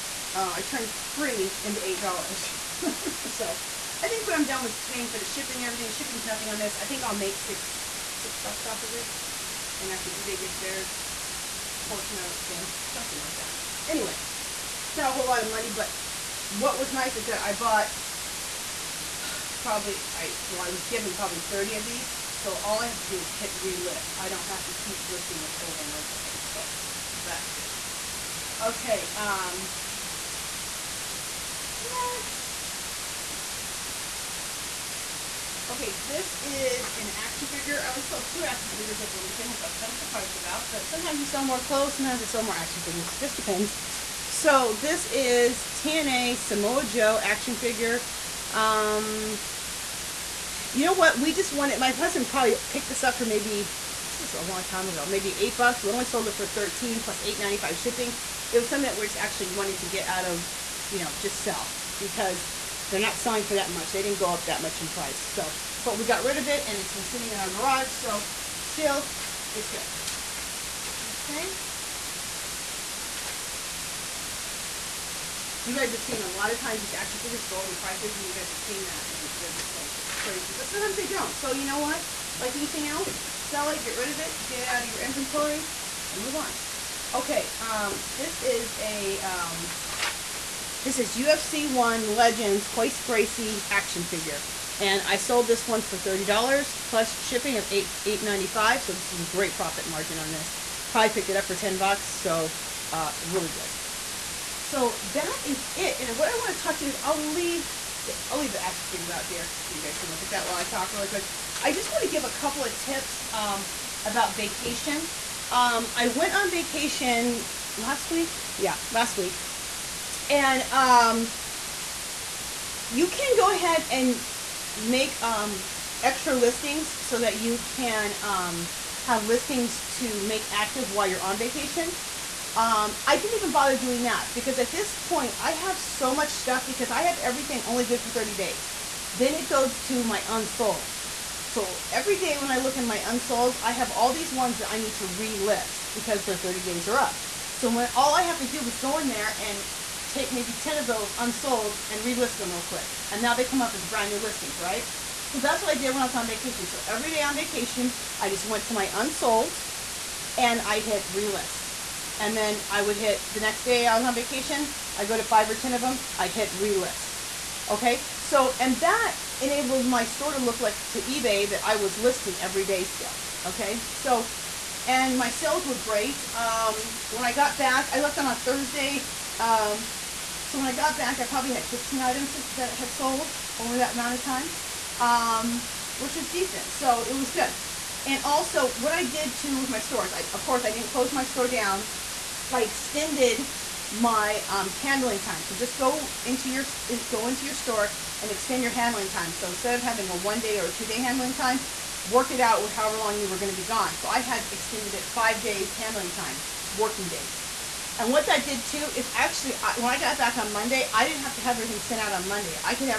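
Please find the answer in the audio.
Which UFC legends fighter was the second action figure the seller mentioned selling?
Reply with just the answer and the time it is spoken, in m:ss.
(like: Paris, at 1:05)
Royce Gracie, at 1:32.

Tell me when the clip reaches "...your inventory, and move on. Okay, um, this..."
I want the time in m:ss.
1:24.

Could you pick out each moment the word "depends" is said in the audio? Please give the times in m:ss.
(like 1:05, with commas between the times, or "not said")
0:43.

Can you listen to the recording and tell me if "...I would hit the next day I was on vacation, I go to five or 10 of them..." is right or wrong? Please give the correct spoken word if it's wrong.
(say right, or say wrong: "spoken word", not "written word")
right.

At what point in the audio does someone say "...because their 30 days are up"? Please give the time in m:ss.
2:25.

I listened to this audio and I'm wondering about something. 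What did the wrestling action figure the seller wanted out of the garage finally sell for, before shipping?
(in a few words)
$13.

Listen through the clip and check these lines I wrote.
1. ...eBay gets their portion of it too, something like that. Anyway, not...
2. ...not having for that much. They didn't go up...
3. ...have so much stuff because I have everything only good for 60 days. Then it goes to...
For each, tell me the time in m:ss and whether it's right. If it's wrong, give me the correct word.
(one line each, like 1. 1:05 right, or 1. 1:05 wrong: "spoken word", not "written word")
1. 0:10 right
2. 1:02 wrong: "selling", not "having"
3. 2:15 wrong: "30", not "60".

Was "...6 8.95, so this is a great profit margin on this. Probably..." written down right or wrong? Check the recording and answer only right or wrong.
wrong.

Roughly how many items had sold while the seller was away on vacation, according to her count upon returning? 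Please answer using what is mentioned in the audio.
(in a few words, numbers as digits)
15.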